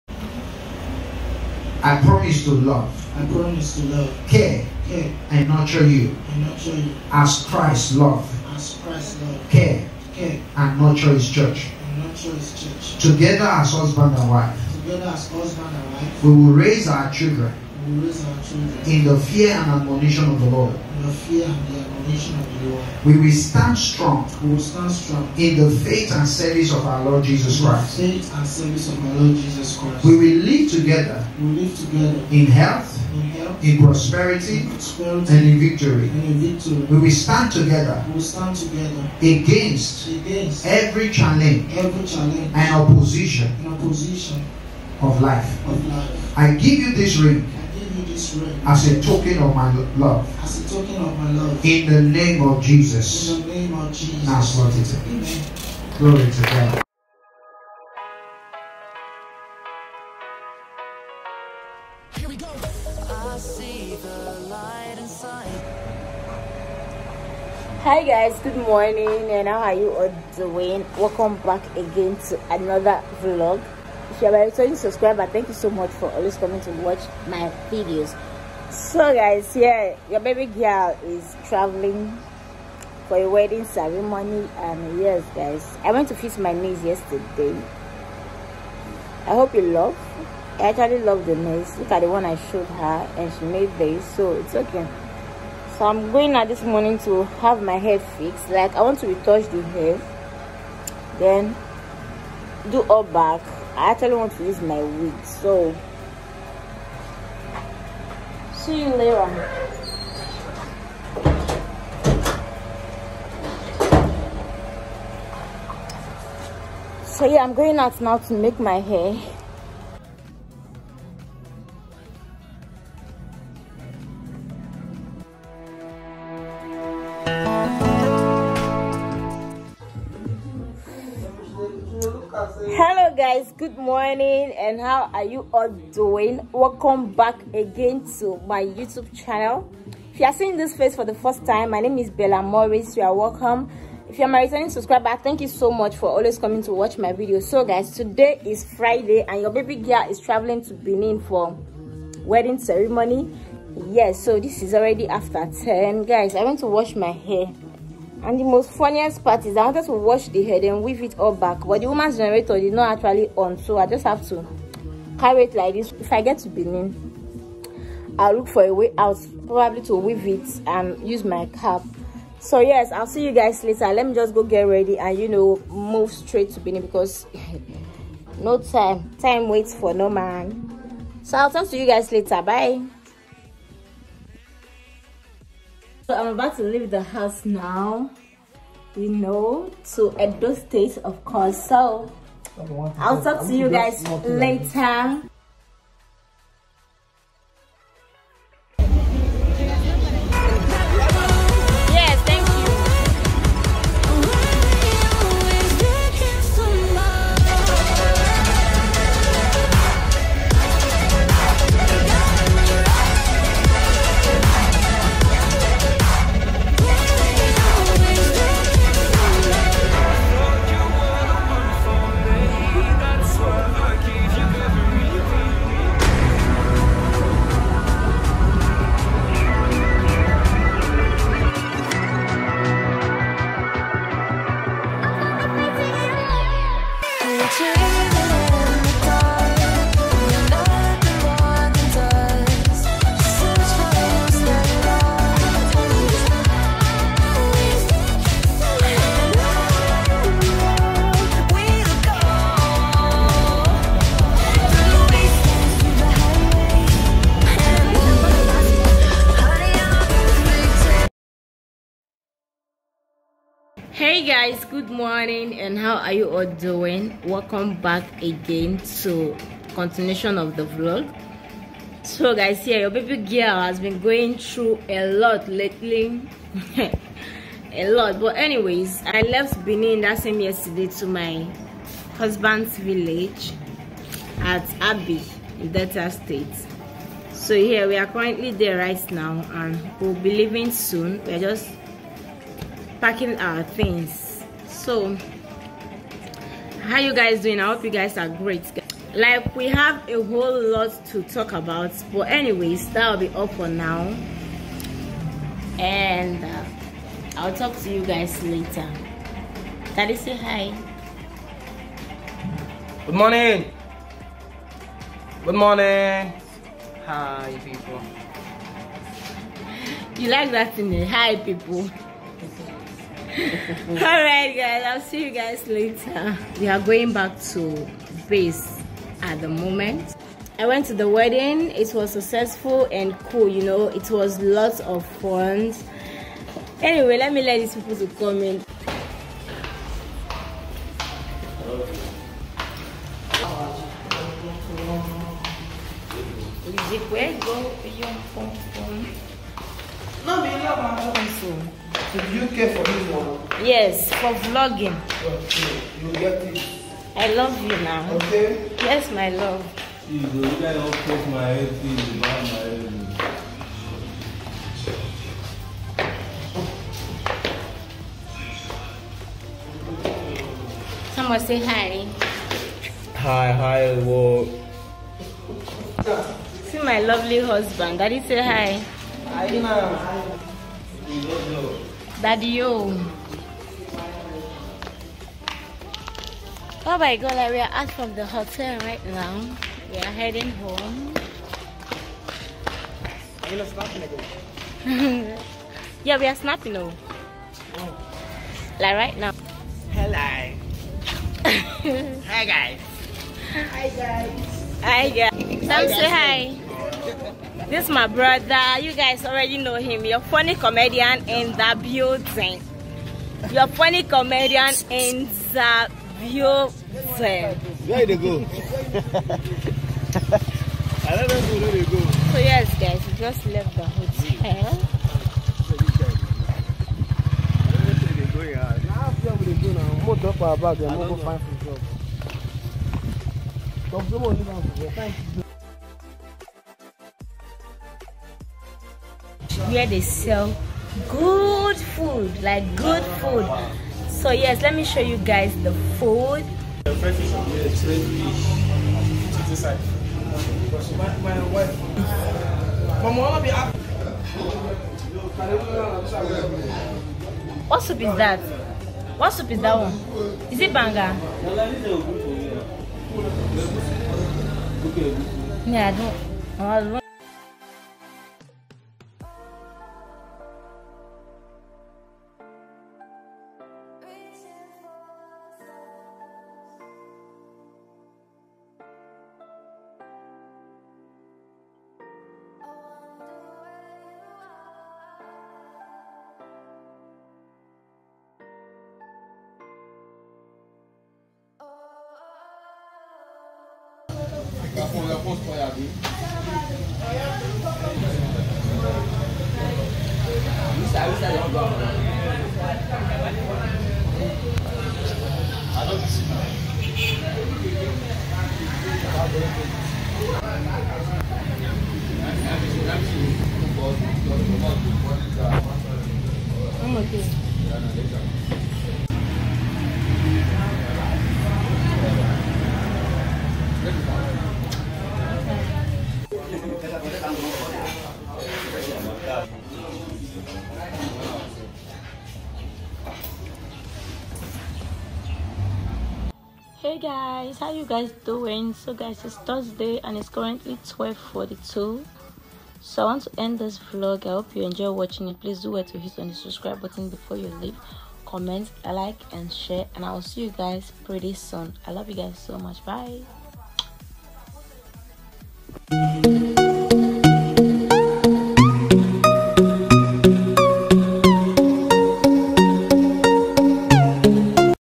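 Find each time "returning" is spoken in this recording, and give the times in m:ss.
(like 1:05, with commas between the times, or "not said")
1:14, 2:24.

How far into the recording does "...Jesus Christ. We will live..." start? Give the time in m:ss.
0:29.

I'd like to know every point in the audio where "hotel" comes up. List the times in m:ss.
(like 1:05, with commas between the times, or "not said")
6:28, 7:03.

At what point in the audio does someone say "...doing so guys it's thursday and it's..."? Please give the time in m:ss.
8:58.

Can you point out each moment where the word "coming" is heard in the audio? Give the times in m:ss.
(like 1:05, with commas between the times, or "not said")
1:16, 2:26.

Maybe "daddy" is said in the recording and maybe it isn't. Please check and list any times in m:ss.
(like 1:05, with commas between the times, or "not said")
5:09, 6:18, 6:22.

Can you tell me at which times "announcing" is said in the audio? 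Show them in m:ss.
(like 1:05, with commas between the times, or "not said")
not said.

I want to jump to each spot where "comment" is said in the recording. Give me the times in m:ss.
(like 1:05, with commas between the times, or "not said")
5:38, 9:08.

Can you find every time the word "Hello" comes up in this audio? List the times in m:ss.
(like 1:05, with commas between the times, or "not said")
2:12, 6:39.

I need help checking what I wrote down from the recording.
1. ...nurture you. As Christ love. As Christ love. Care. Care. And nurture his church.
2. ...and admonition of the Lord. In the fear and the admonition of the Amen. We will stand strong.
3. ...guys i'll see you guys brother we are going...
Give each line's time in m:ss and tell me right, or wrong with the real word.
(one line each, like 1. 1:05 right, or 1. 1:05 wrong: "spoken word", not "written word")
1. 0:06 right
2. 0:19 wrong: "Lord", not "Amen"
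3. 5:24 wrong: "later", not "brother".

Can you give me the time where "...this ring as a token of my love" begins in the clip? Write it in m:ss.
0:46.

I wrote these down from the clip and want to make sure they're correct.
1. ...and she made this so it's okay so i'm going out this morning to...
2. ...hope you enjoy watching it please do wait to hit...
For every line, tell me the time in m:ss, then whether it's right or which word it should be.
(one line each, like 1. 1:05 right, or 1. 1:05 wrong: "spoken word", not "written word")
1. 1:33 right
2. 9:04 right.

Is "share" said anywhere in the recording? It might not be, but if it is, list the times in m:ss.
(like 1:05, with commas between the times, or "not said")
9:09.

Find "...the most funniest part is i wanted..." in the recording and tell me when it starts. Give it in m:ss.
2:38.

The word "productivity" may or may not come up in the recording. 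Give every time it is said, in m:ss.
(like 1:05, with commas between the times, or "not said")
not said.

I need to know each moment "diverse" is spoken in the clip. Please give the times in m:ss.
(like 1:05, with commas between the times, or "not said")
not said.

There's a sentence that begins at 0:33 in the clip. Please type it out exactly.
In prosperity, in prosperity and in victory.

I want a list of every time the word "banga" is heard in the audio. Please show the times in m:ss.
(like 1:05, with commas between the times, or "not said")
7:40.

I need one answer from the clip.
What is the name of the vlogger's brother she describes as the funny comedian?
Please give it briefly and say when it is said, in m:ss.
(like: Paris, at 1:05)
Sam, at 6:45.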